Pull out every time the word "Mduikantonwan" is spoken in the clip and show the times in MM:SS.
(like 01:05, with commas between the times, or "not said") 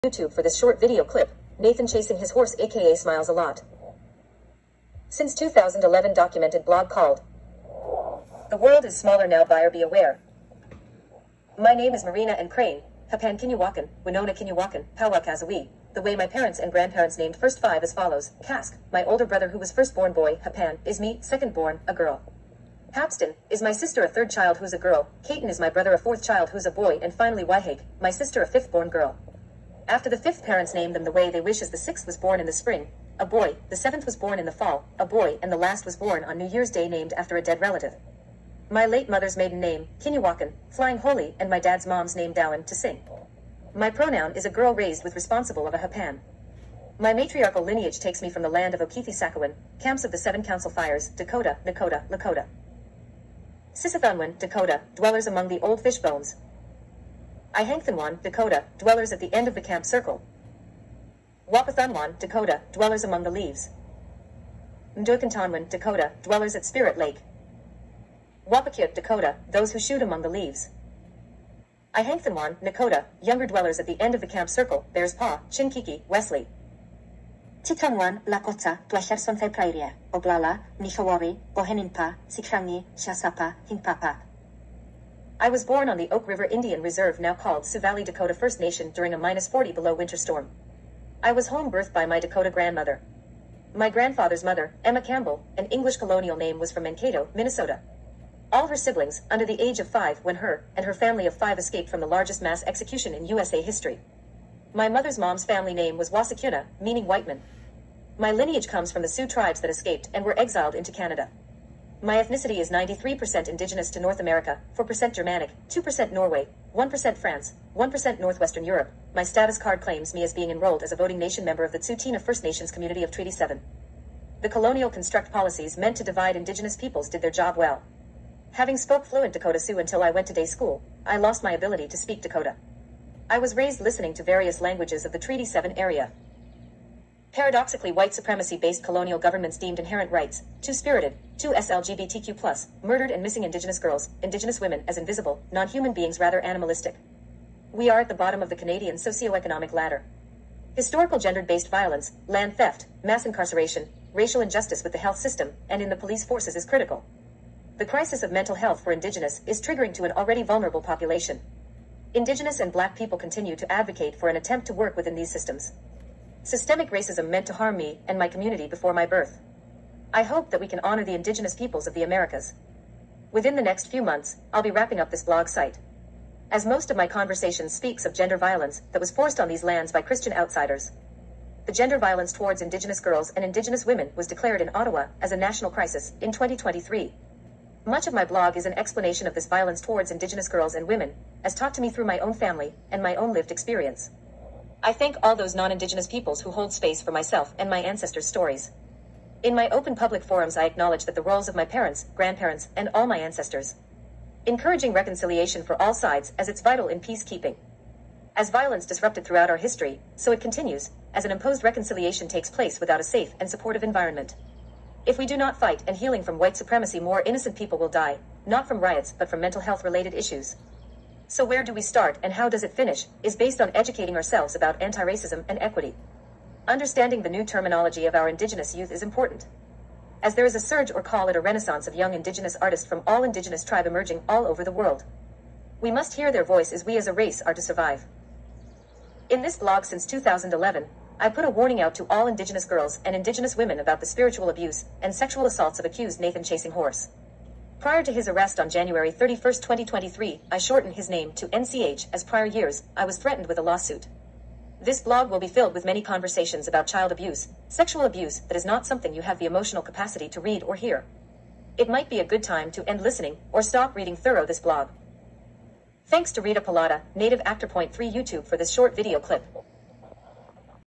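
01:04.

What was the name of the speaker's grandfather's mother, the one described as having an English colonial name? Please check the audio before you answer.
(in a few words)
Emma Campbell.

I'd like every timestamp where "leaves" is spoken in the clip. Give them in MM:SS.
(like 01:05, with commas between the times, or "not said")
01:03, 01:10.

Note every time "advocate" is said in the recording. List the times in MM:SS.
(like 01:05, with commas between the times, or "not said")
02:43.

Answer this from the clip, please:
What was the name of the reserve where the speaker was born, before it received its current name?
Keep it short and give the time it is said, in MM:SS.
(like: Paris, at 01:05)
Oak River Indian Reserve, at 01:26.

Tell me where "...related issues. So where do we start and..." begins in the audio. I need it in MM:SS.
03:39.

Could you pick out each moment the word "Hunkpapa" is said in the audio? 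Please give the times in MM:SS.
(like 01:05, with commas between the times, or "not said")
01:23.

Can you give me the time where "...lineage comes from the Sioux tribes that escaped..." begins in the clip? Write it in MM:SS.
01:48.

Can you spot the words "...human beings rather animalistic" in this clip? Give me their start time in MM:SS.
02:25.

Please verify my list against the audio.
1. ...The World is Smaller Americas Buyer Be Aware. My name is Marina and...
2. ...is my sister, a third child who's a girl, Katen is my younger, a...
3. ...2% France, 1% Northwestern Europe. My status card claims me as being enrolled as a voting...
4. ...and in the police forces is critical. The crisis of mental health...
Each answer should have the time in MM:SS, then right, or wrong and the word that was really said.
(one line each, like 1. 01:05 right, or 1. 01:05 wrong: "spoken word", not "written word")
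1. 00:08 wrong: "Now", not "Americas"
2. 00:23 wrong: "brother", not "younger"
3. 01:56 wrong: "1", not "2"
4. 02:35 right.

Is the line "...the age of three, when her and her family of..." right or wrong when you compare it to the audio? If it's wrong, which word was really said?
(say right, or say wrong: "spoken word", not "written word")
wrong: "five", not "three".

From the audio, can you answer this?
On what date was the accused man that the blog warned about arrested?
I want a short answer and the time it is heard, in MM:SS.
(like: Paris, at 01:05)
January 31, 2023, at 04:08.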